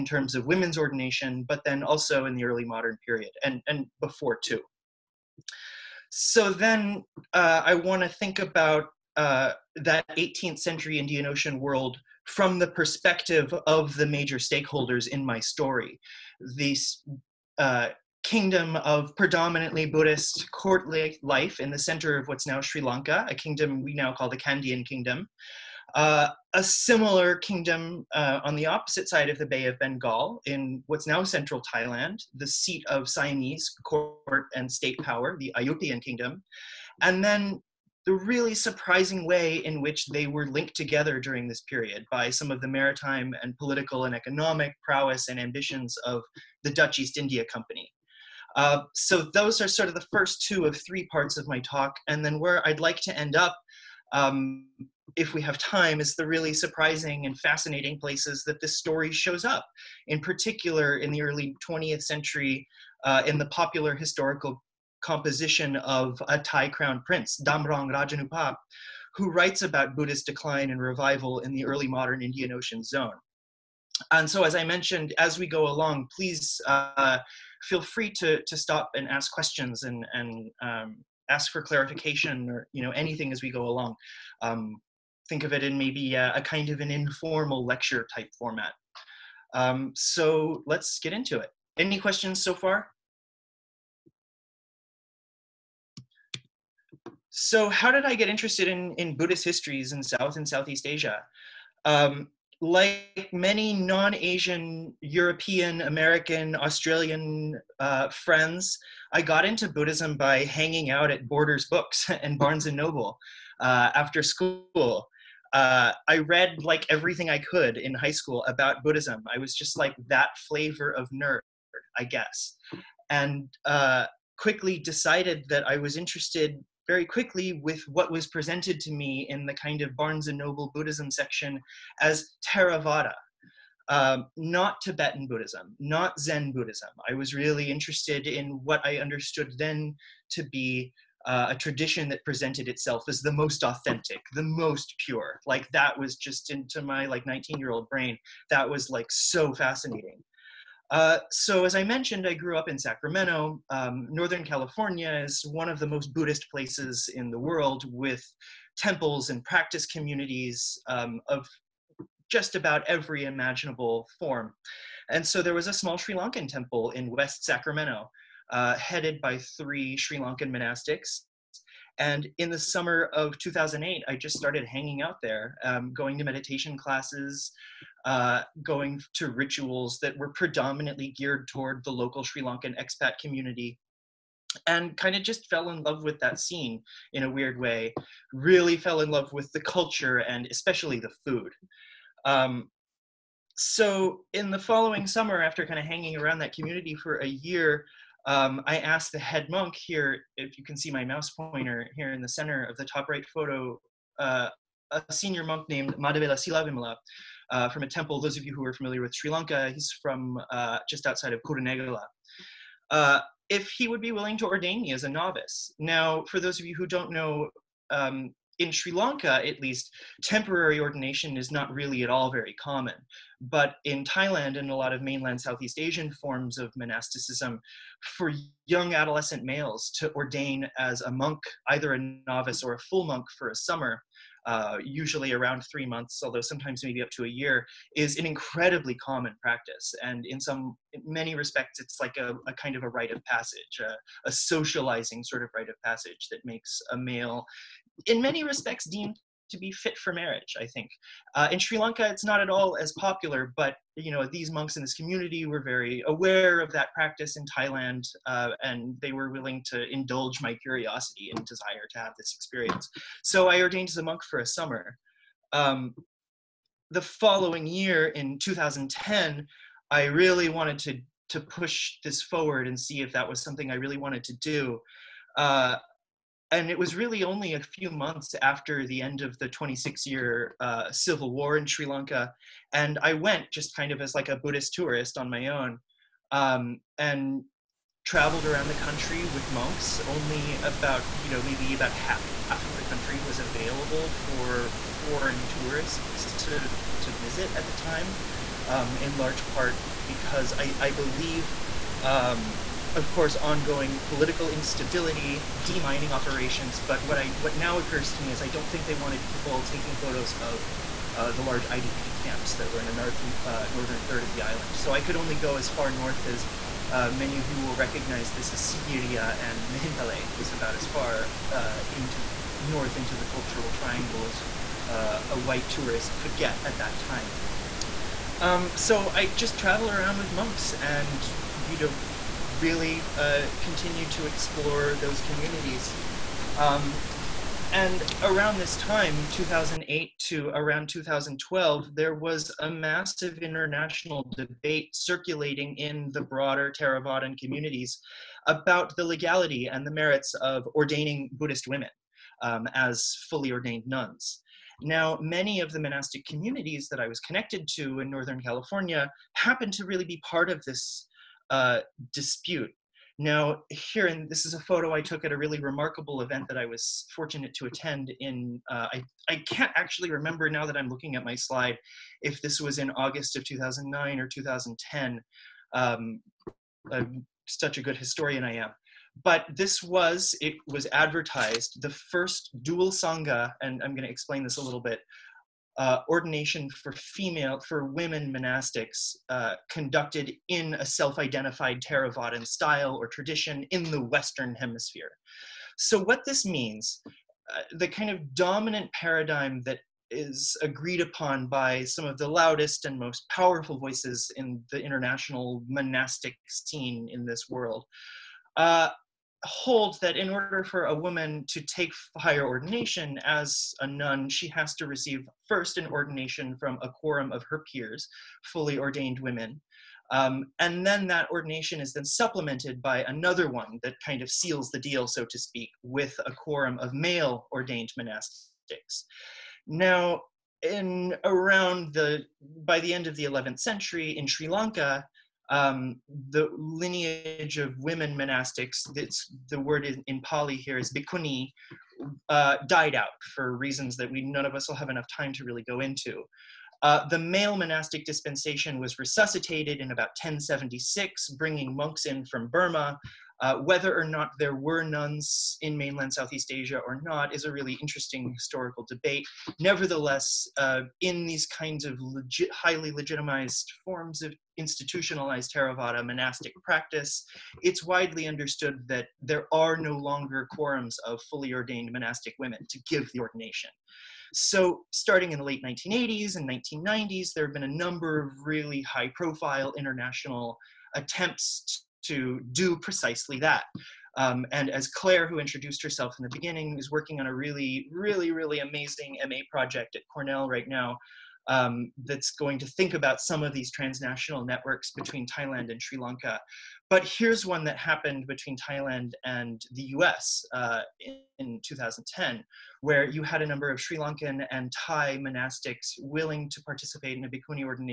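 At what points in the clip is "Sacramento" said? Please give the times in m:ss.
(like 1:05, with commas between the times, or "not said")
2:32, 2:47.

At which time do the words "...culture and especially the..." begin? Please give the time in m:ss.
3:09.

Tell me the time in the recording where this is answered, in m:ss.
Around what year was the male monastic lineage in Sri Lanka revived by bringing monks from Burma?
7:30.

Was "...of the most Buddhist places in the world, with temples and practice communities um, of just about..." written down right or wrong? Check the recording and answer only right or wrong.
right.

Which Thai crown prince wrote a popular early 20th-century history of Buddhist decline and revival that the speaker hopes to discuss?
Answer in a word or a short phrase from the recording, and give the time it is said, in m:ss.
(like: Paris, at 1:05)
Damrong Rajanubhab, at 1:07.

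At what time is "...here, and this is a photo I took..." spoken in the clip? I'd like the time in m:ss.
6:03.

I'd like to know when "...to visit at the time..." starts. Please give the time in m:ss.
4:57.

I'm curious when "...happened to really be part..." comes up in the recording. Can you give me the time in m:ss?
5:59.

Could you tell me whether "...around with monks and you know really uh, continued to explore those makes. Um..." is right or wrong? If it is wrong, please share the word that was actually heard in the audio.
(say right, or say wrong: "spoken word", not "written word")
wrong: "communities", not "makes".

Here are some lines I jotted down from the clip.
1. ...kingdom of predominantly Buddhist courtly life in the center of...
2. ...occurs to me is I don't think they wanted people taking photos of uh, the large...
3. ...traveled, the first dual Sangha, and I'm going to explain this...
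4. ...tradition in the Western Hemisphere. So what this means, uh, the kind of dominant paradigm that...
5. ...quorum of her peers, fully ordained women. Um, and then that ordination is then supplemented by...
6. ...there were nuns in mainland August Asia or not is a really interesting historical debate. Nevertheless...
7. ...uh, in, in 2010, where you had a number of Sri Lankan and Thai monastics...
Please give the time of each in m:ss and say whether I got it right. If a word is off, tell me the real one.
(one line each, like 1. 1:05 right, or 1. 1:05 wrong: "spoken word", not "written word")
1. 0:18 right
2. 5:07 right
3. 6:20 wrong: "advertised", not "traveled"
4. 6:33 right
5. 6:56 right
6. 7:34 wrong: "Southeast", not "August"
7. 8:20 right.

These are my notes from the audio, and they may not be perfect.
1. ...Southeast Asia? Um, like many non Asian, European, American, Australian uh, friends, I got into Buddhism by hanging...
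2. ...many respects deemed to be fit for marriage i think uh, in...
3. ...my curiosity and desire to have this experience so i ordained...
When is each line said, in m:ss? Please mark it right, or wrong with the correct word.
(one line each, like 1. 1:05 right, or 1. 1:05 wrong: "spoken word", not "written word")
1. 1:40 right
2. 4:08 right
3. 4:20 right.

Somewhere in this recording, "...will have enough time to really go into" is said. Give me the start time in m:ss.
7:24.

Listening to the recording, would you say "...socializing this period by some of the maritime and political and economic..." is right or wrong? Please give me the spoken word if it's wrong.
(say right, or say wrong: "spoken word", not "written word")
wrong: "during", not "socializing".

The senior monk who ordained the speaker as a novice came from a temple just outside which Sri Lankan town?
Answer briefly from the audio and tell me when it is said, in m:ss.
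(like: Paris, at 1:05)
Kurunegala, at 3:31.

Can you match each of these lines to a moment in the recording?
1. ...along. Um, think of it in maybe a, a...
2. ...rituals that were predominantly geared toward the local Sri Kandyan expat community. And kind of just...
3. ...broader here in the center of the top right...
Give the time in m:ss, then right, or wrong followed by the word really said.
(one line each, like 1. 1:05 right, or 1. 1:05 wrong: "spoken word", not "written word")
1. 1:23 right
2. 2:59 wrong: "Lankan", not "Kandyan"
3. 3:21 wrong: "pointer", not "broader".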